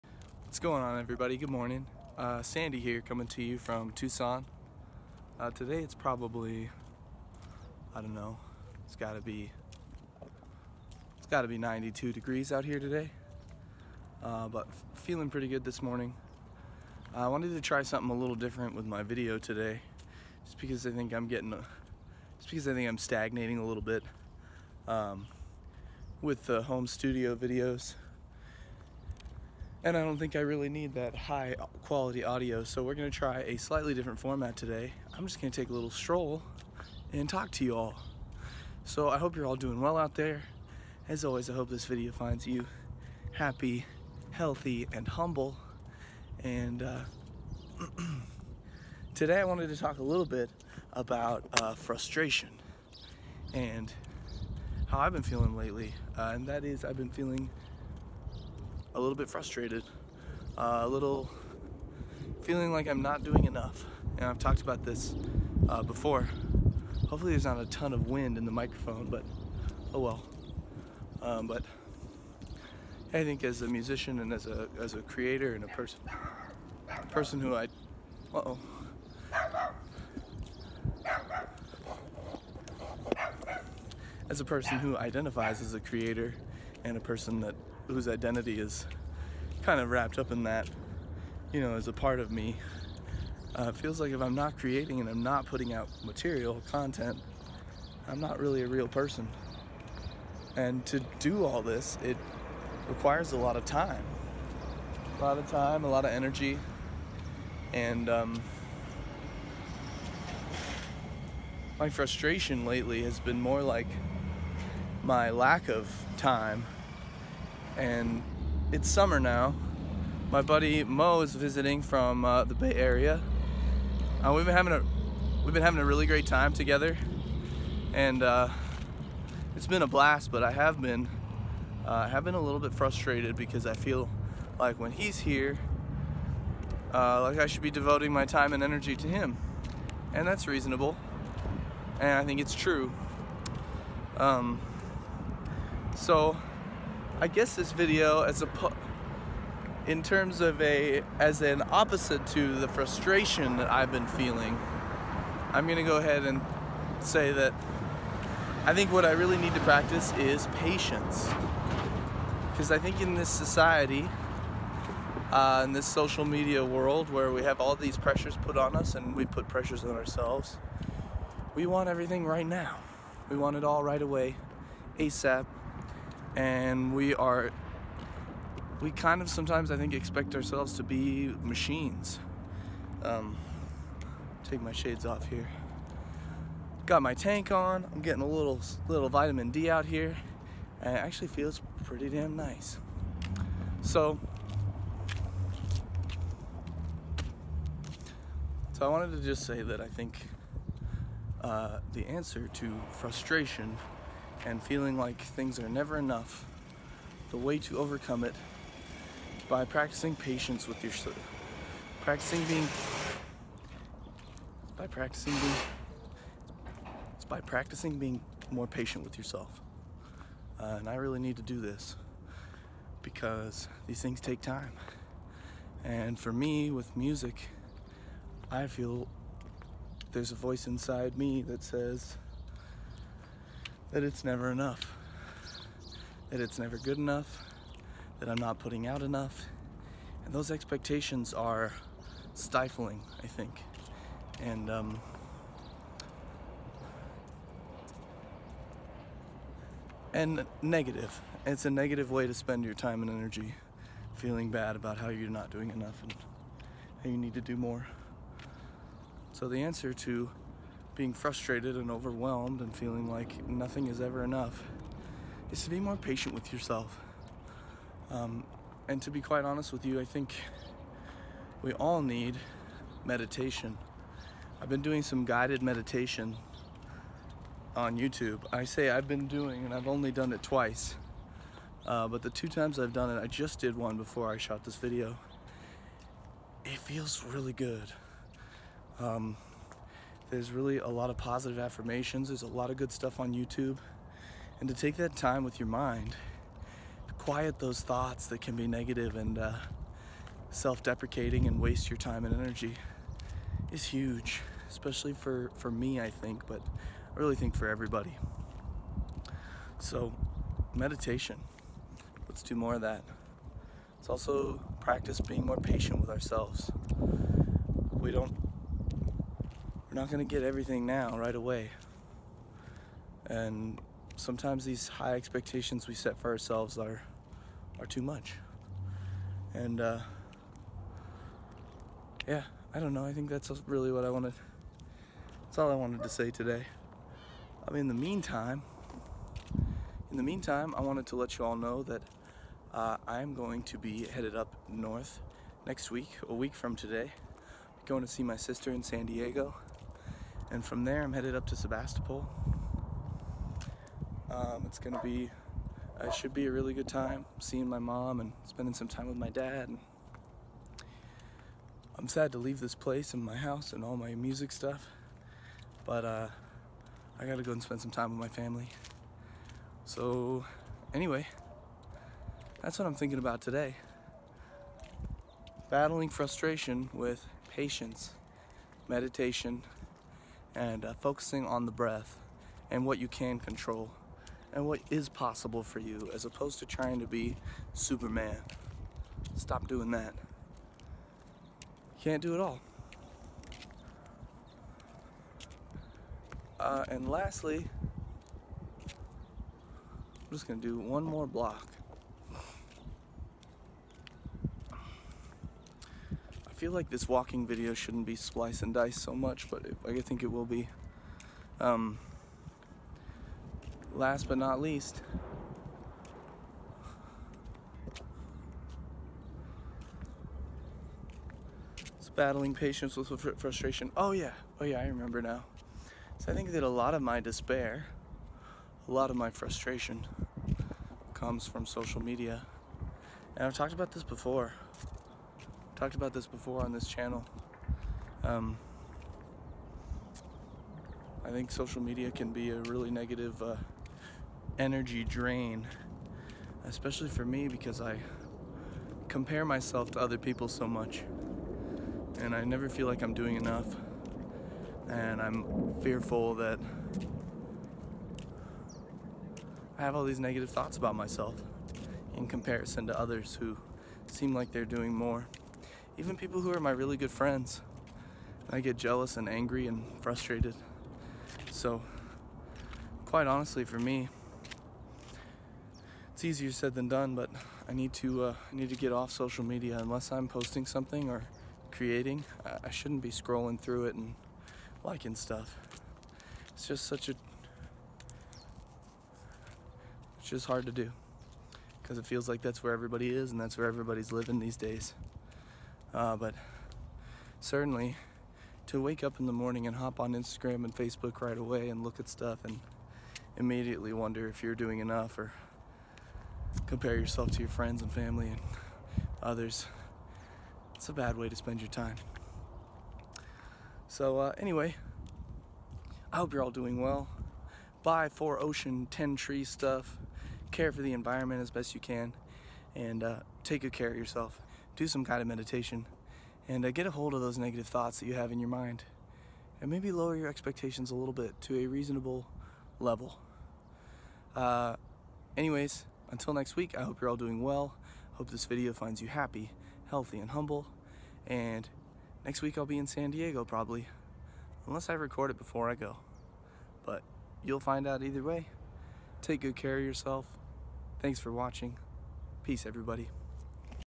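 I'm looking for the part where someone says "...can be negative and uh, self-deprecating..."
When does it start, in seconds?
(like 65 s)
298 s.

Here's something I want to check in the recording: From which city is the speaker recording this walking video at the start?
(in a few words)
Tucson.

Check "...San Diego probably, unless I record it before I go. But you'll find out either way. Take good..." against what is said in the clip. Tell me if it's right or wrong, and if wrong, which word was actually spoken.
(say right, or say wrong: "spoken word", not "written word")
right.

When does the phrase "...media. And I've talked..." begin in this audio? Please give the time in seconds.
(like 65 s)
432 s.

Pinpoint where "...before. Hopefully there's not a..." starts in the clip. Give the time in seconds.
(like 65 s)
65 s.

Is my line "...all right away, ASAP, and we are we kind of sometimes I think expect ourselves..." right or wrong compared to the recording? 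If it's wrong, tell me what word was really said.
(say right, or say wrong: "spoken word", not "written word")
right.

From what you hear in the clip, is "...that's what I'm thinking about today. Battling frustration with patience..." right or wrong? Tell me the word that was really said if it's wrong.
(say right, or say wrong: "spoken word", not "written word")
right.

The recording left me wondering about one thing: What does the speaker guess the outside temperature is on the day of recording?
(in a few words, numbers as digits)
92 degrees.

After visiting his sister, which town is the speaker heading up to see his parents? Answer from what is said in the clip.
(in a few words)
Sebastopol.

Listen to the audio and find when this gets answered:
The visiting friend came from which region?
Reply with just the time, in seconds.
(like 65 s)
122 s.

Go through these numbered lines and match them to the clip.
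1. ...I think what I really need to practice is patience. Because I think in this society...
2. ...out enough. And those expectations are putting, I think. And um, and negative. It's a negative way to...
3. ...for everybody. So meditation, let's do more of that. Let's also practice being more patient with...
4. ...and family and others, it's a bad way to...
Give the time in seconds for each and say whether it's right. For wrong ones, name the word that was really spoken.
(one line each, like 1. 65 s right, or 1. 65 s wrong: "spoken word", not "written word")
1. 158 s right
2. 238 s wrong: "stifling", not "putting"
3. 307 s right
4. 507 s right.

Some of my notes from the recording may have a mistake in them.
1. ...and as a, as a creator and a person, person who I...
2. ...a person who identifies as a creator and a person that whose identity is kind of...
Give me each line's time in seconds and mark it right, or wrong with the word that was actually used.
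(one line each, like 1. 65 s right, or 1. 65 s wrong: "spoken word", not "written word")
1. 74 s right
2. 84 s right.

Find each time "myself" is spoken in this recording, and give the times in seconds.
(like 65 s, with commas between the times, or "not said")
449 s, 460 s.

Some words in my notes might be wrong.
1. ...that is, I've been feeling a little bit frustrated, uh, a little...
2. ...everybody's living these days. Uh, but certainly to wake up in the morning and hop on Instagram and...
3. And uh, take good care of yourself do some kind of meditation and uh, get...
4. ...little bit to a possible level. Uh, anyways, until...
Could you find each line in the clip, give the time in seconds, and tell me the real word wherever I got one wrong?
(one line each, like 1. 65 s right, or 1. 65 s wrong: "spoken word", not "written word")
1. 56 s right
2. 493 s right
3. 522 s right
4. 530 s wrong: "reasonable", not "possible".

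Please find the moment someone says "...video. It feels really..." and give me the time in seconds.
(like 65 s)
284 s.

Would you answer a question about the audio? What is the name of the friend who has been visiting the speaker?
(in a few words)
Mo.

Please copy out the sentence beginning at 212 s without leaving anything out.
Practicing being by practicing being it's by practicing being more patient with yourself.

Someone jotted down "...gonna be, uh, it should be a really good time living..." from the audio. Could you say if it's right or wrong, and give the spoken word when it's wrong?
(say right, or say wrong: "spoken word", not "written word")
wrong: "seeing", not "living".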